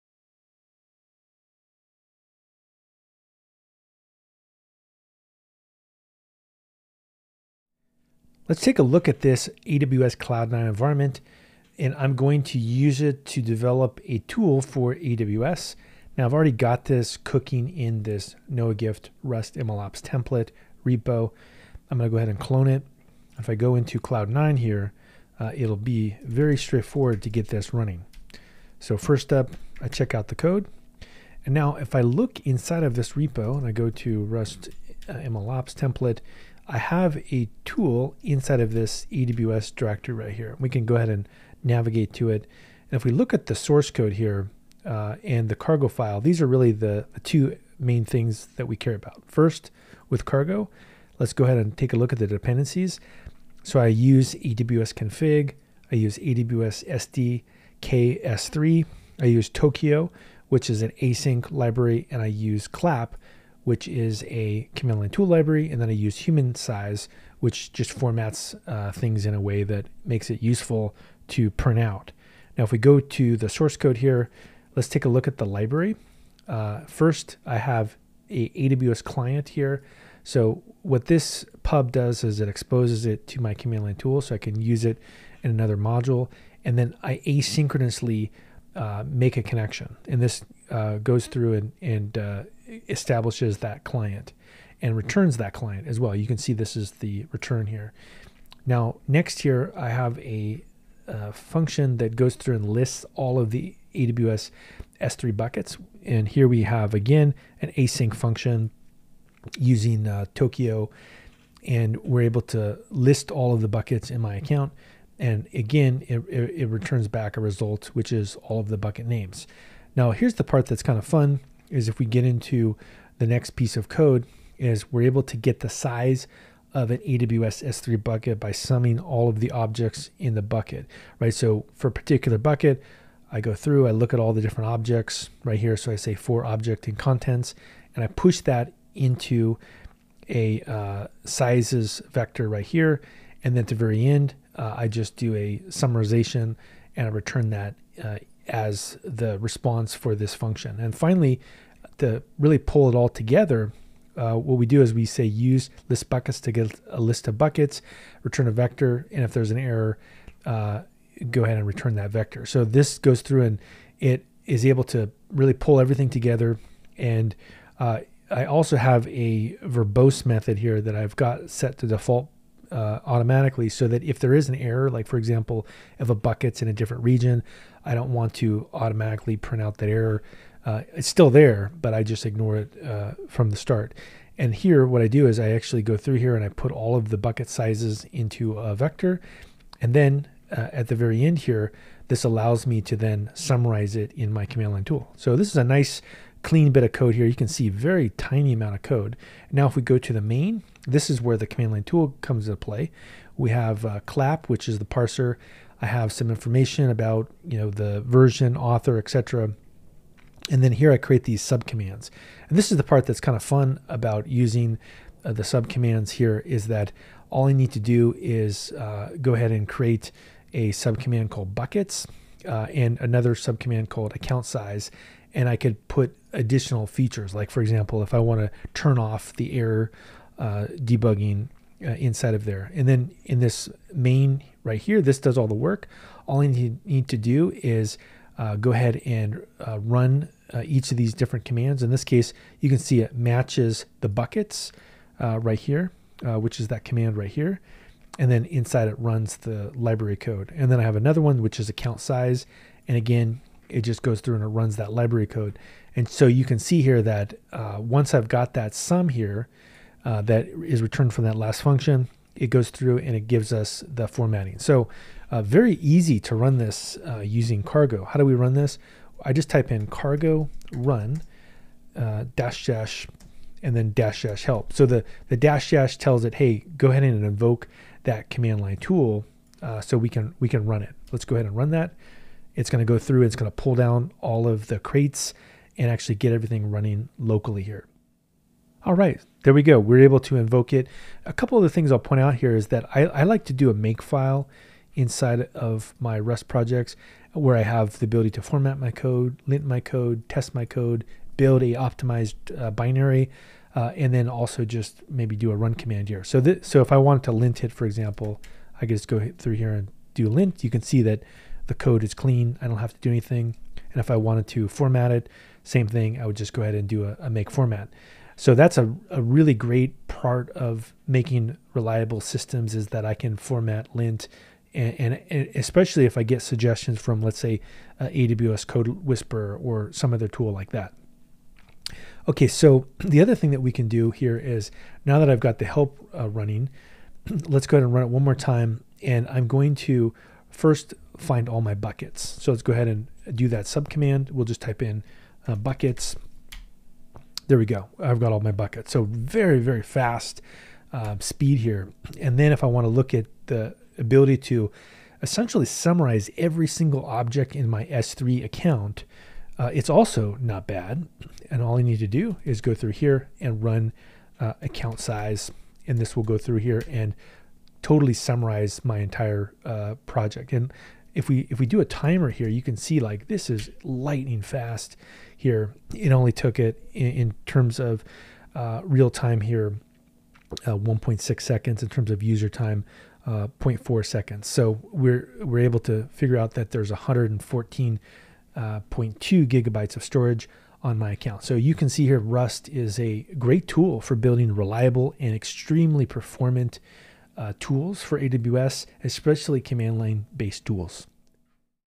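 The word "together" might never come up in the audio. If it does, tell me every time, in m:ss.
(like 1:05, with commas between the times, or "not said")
2:33, 2:46.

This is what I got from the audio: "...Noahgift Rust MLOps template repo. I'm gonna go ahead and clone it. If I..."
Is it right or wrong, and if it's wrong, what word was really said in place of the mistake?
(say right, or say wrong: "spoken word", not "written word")
right.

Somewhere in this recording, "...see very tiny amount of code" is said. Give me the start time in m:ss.
3:17.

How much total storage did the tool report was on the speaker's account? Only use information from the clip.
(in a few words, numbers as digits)
114.2 gigabytes.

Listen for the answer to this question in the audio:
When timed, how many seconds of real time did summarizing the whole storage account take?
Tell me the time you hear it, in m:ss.
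6:20.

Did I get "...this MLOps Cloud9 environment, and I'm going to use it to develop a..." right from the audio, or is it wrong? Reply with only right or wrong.
wrong.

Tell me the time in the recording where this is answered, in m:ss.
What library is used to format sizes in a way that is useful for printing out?
1:06.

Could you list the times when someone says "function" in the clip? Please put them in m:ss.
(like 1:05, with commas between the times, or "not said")
1:41, 1:48, 2:30, 4:21.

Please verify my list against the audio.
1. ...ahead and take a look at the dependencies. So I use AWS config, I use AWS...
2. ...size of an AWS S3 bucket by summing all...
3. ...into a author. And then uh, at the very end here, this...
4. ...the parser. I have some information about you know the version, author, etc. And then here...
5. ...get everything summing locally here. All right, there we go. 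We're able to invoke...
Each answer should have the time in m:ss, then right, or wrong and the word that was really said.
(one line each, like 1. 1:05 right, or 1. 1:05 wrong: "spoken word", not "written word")
1. 0:51 right
2. 2:05 right
3. 3:08 wrong: "vector", not "author"
4. 3:24 right
5. 4:46 wrong: "running", not "summing".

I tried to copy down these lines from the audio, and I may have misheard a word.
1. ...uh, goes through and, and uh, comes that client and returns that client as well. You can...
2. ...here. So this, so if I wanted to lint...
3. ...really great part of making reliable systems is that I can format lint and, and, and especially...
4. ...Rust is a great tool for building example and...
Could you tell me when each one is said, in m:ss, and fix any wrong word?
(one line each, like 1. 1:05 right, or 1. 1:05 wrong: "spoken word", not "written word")
1. 1:30 wrong: "establishes", not "comes"
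2. 5:06 right
3. 5:19 right
4. 6:32 wrong: "reliable", not "example".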